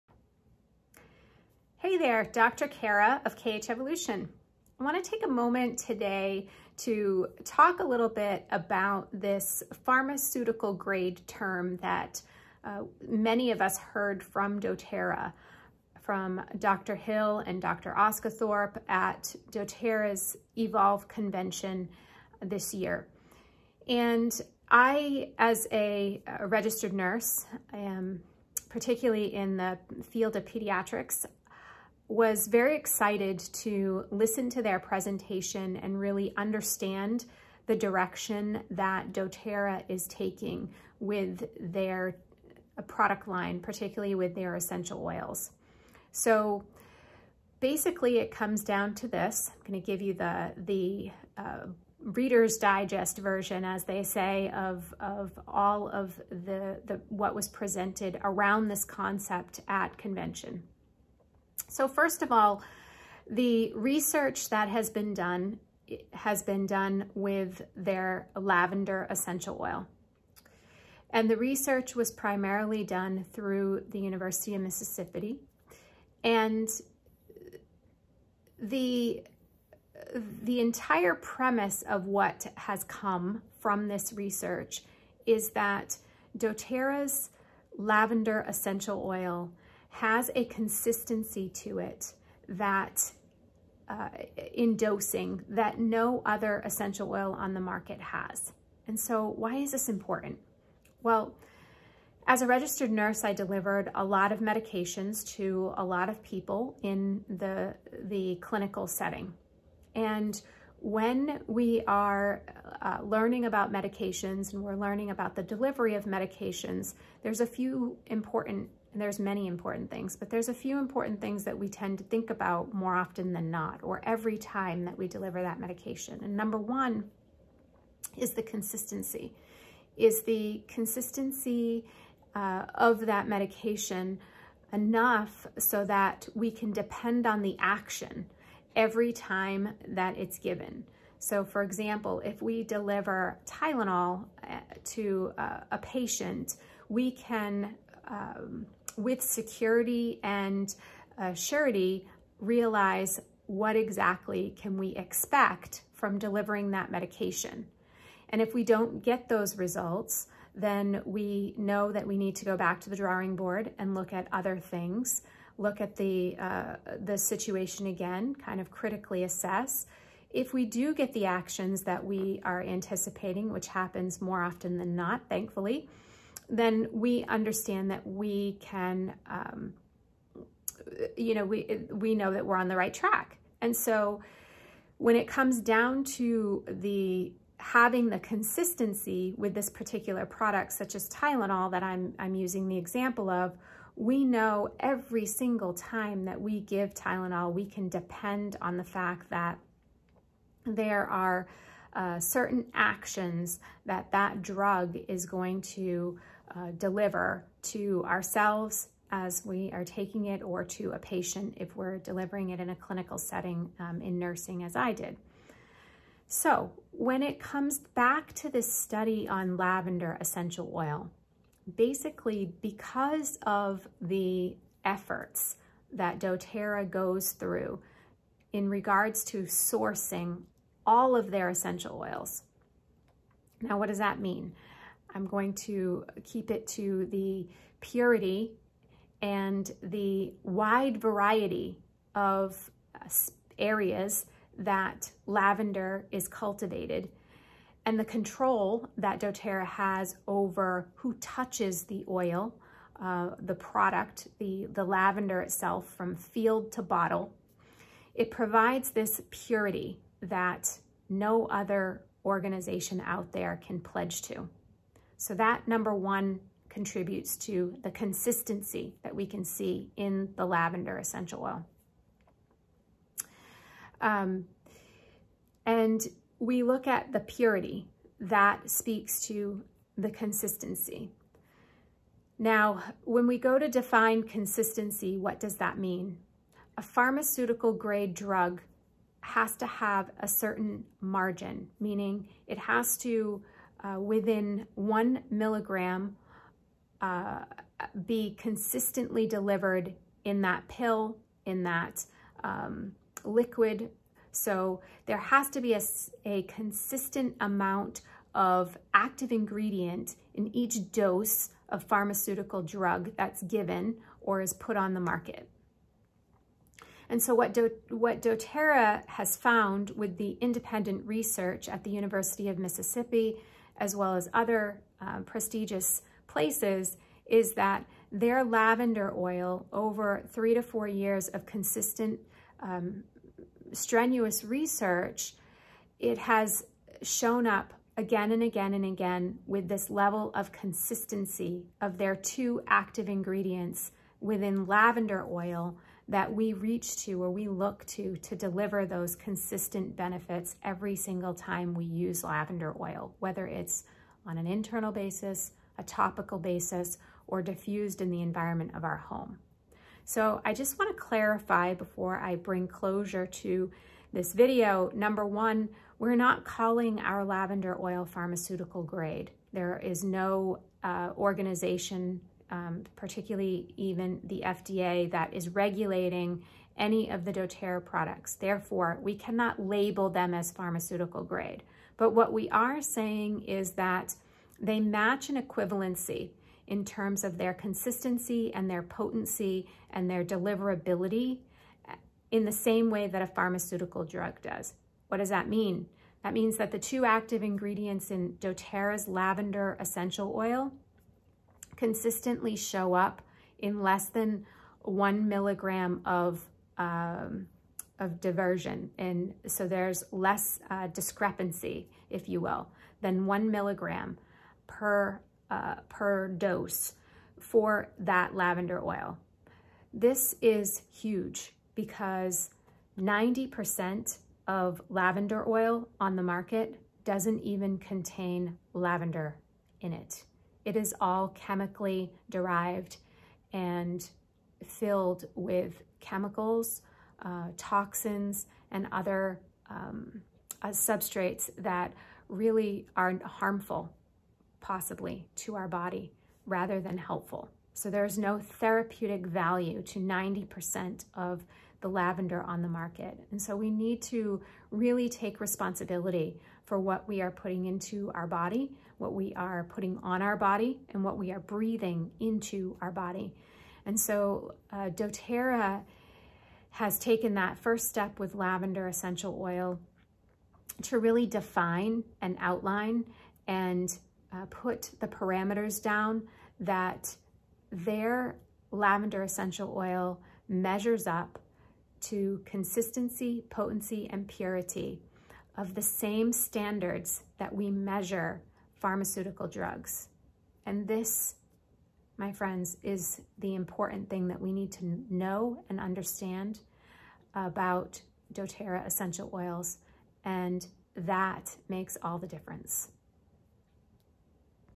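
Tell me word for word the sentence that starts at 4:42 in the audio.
Now, when we go to define consistency, what does that mean?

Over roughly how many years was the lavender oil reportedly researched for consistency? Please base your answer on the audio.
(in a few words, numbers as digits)
3 to 4 years.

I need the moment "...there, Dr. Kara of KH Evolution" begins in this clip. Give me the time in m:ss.
0:01.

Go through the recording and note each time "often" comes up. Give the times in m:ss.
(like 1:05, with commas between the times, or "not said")
2:02, 2:54.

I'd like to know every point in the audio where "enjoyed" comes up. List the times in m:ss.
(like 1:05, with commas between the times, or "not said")
not said.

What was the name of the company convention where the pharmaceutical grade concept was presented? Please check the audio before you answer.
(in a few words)
Evolve.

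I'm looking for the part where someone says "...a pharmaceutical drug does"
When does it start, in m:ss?
6:33.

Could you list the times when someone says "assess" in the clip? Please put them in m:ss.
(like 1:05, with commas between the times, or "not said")
2:49.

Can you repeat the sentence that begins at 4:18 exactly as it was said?
It provides this purity that no other organization out there can pledge to.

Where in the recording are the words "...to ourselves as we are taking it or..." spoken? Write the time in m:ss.
3:27.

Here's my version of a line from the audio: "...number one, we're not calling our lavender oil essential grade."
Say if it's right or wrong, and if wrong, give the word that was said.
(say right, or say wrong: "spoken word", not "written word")
wrong: "pharmaceutical", not "essential".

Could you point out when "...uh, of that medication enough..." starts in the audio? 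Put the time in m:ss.
2:12.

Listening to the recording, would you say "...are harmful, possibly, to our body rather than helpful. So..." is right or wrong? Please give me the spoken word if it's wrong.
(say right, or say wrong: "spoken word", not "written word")
right.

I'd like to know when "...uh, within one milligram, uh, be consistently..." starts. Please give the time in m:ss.
4:53.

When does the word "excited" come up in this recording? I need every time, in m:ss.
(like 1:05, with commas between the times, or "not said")
0:32.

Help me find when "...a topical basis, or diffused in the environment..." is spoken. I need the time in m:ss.
5:55.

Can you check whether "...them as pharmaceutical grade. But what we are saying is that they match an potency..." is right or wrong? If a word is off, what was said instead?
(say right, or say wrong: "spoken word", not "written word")
wrong: "equivalency", not "potency".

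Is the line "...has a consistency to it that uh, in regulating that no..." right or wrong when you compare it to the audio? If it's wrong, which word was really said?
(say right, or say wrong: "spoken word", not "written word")
wrong: "dosing", not "regulating".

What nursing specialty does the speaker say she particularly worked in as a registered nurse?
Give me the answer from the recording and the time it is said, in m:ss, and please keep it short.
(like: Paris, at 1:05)
pediatrics, at 0:30.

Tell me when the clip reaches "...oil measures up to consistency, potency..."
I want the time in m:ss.
7:59.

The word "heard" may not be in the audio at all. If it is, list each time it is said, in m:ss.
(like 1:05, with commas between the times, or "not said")
0:13.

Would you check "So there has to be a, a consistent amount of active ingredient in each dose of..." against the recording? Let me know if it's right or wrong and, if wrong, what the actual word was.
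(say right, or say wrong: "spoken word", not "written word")
right.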